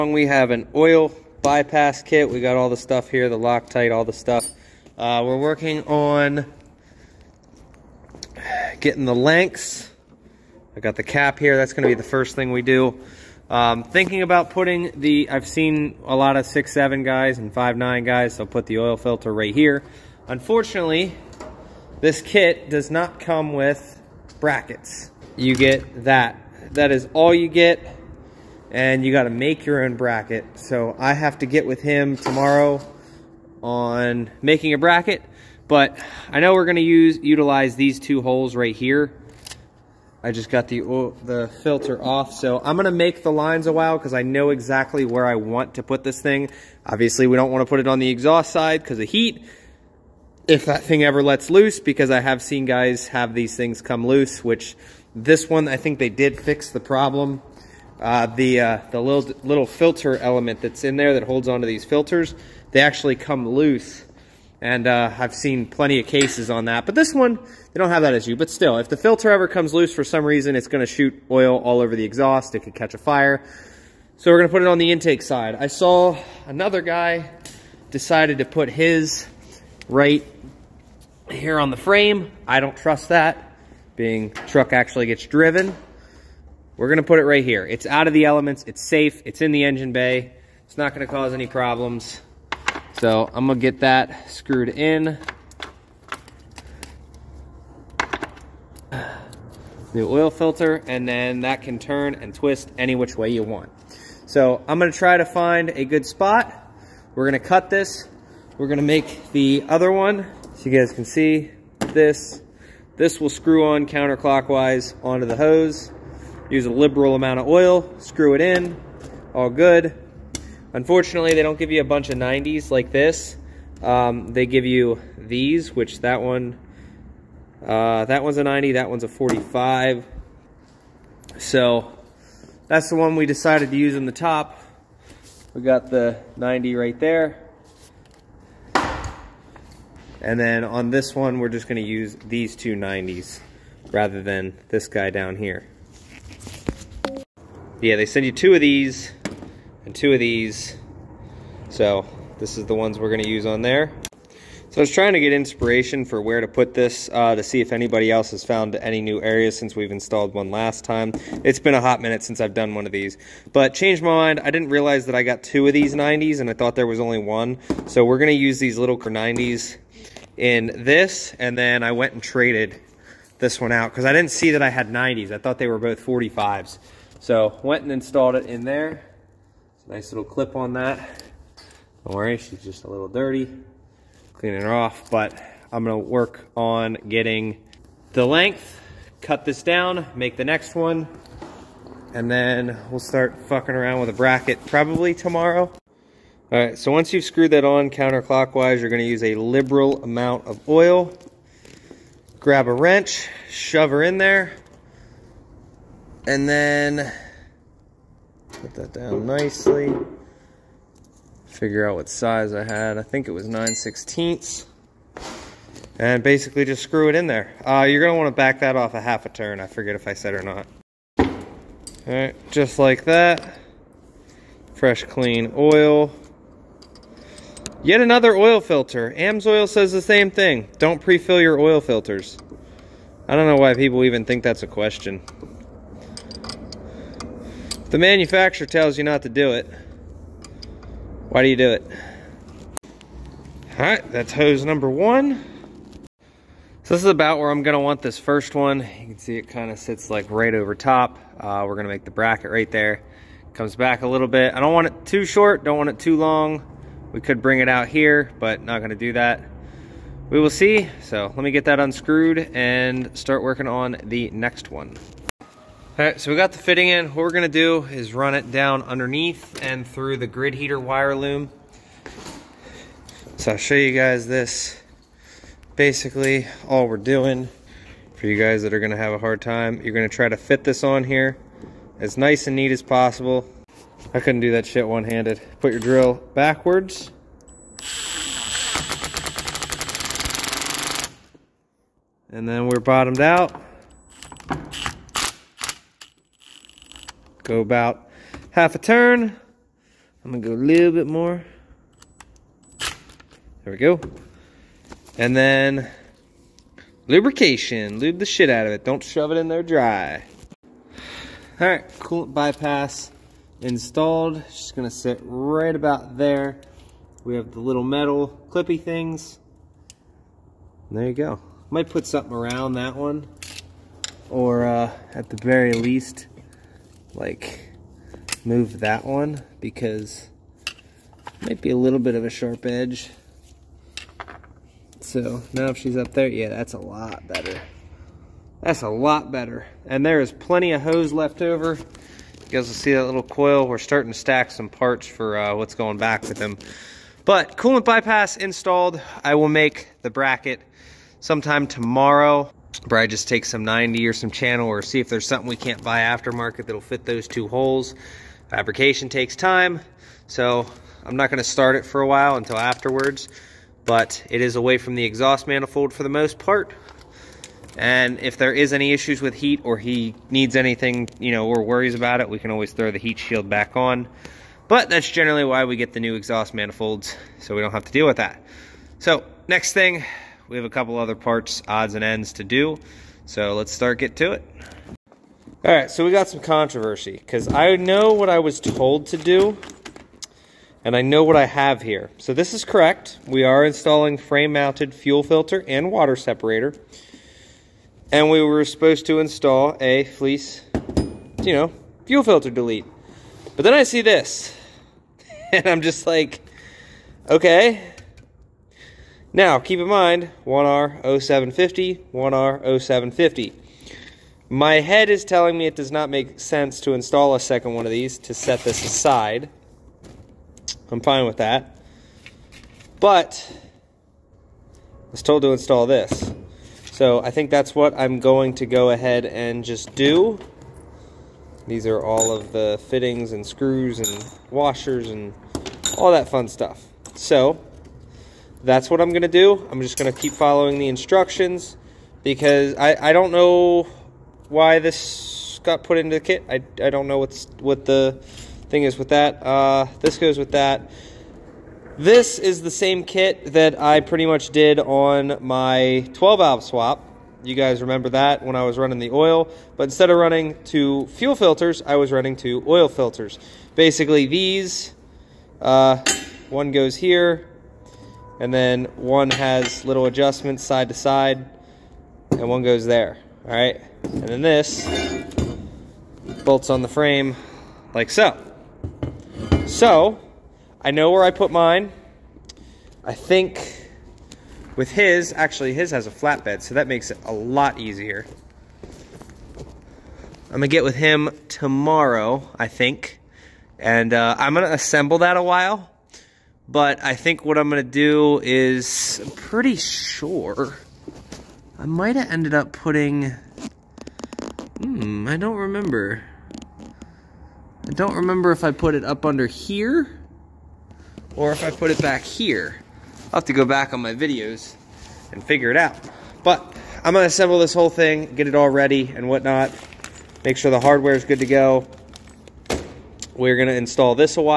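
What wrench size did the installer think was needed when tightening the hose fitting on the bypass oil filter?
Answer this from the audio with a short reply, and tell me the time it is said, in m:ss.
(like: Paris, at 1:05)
9/16, at 3:33.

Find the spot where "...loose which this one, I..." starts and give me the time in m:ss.
0:54.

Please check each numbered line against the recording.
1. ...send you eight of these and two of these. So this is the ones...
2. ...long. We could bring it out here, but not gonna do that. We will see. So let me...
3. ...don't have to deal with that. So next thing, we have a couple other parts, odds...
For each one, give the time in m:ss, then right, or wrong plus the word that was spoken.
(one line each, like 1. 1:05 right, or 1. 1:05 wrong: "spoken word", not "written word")
1. 2:28 wrong: "two", not "eight"
2. 4:16 right
3. 6:17 right.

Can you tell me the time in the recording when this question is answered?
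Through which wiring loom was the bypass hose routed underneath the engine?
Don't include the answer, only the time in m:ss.
4:30.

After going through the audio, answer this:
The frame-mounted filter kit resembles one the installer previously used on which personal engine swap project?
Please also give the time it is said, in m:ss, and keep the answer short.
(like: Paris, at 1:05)
12 valve swap, at 7:36.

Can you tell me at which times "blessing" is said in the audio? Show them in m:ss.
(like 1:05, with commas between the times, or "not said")
not said.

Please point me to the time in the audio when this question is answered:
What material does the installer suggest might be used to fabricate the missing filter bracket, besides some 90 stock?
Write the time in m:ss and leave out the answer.
5:54.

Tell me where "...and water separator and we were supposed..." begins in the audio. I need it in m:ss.
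6:35.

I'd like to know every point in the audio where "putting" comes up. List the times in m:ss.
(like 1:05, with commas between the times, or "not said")
0:14, 8:22.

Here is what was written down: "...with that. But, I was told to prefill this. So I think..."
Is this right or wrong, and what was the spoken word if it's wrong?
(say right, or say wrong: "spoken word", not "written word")
wrong: "install", not "prefill".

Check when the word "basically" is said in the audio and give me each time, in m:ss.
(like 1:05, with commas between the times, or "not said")
3:36, 4:35, 7:43.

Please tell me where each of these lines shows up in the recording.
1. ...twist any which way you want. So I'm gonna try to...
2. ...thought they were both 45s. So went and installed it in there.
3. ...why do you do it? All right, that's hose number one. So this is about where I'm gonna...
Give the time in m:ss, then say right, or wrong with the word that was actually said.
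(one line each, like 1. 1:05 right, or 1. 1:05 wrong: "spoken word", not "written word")
1. 1:42 right
2. 2:55 right
3. 4:01 right.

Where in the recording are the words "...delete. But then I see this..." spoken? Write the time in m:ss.
6:42.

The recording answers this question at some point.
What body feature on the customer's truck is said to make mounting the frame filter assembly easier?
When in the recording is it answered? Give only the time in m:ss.
8:06.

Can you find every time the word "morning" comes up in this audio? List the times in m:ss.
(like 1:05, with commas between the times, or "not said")
not said.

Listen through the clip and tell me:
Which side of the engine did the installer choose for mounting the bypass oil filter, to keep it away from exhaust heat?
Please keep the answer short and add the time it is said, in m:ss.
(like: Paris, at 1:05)
Intake side, at 1:14.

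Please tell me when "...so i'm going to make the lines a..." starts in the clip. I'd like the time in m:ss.
0:42.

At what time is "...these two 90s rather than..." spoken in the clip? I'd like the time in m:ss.
2:22.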